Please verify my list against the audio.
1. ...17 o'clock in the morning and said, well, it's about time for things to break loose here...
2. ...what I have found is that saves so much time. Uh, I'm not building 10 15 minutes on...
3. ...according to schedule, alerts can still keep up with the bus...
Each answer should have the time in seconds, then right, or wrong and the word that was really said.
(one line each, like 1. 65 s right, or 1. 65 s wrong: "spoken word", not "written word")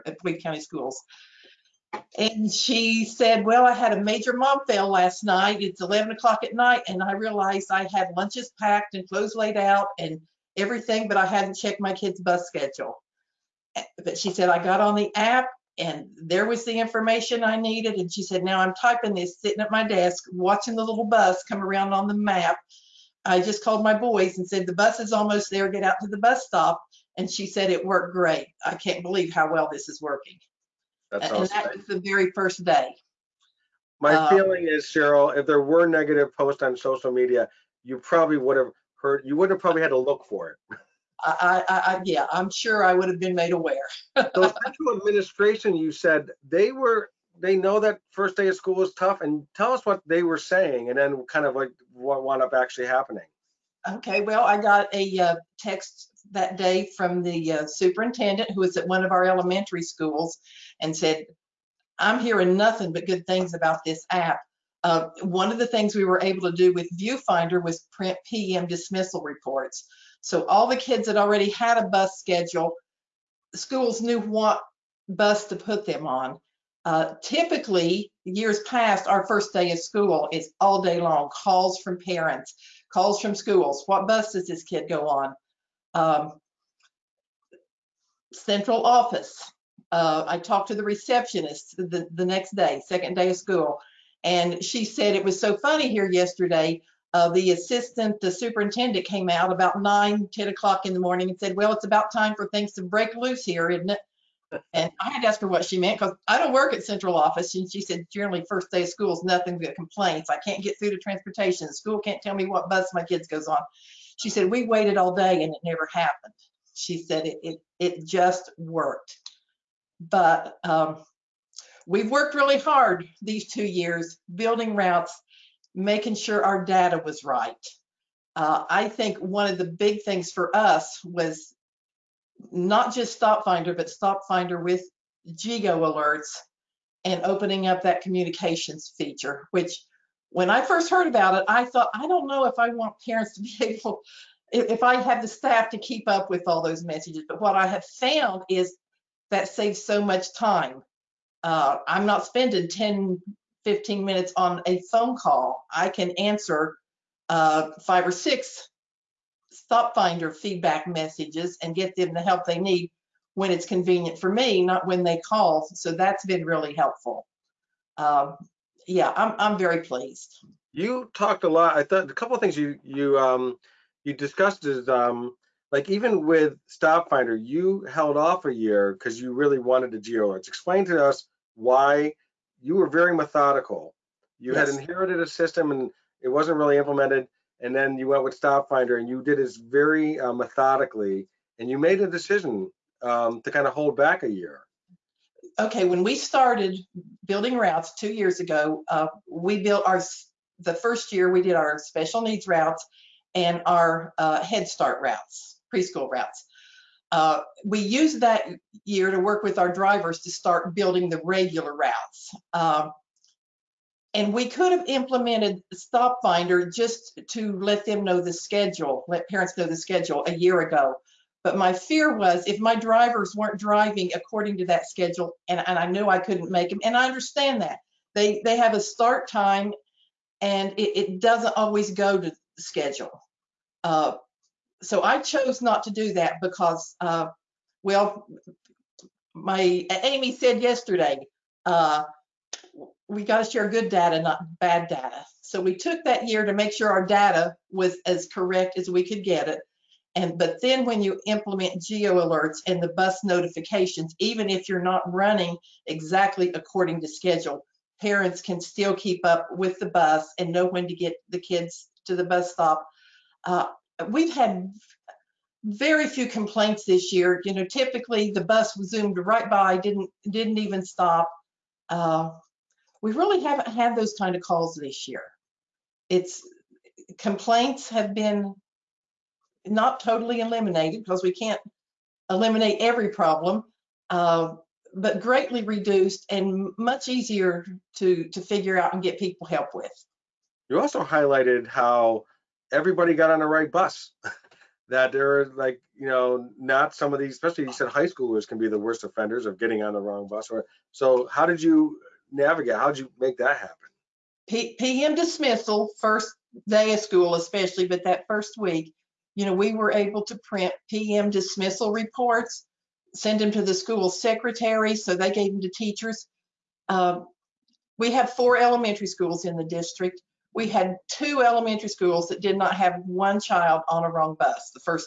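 1. 100 s wrong: "10", not "17"
2. 147 s wrong: "spending", not "building"
3. 256 s wrong: "parents", not "alerts".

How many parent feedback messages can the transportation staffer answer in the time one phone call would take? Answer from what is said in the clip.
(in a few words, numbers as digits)
5 or 6.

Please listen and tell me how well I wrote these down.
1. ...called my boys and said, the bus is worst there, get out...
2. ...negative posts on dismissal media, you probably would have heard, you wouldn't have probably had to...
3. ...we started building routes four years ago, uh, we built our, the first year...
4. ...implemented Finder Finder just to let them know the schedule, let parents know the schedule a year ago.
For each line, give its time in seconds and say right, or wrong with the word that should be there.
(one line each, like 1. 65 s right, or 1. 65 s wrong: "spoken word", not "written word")
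1. 23 s wrong: "almost", not "worst"
2. 35 s wrong: "social", not "dismissal"
3. 196 s wrong: "two", not "four"
4. 214 s wrong: "Stop", not "Finder".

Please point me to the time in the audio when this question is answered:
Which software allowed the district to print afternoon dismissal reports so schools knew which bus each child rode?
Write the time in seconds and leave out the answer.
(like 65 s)
66 s.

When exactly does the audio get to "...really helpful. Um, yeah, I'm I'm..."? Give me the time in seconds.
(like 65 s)
166 s.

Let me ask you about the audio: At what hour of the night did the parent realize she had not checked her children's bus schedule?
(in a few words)
11 o'clock.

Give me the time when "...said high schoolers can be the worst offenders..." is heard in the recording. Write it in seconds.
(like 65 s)
297 s.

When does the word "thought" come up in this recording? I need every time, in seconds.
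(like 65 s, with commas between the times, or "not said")
141 s, 171 s.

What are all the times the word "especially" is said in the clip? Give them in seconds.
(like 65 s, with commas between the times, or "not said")
297 s, 307 s.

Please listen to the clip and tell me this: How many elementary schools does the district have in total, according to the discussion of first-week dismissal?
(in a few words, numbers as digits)
4.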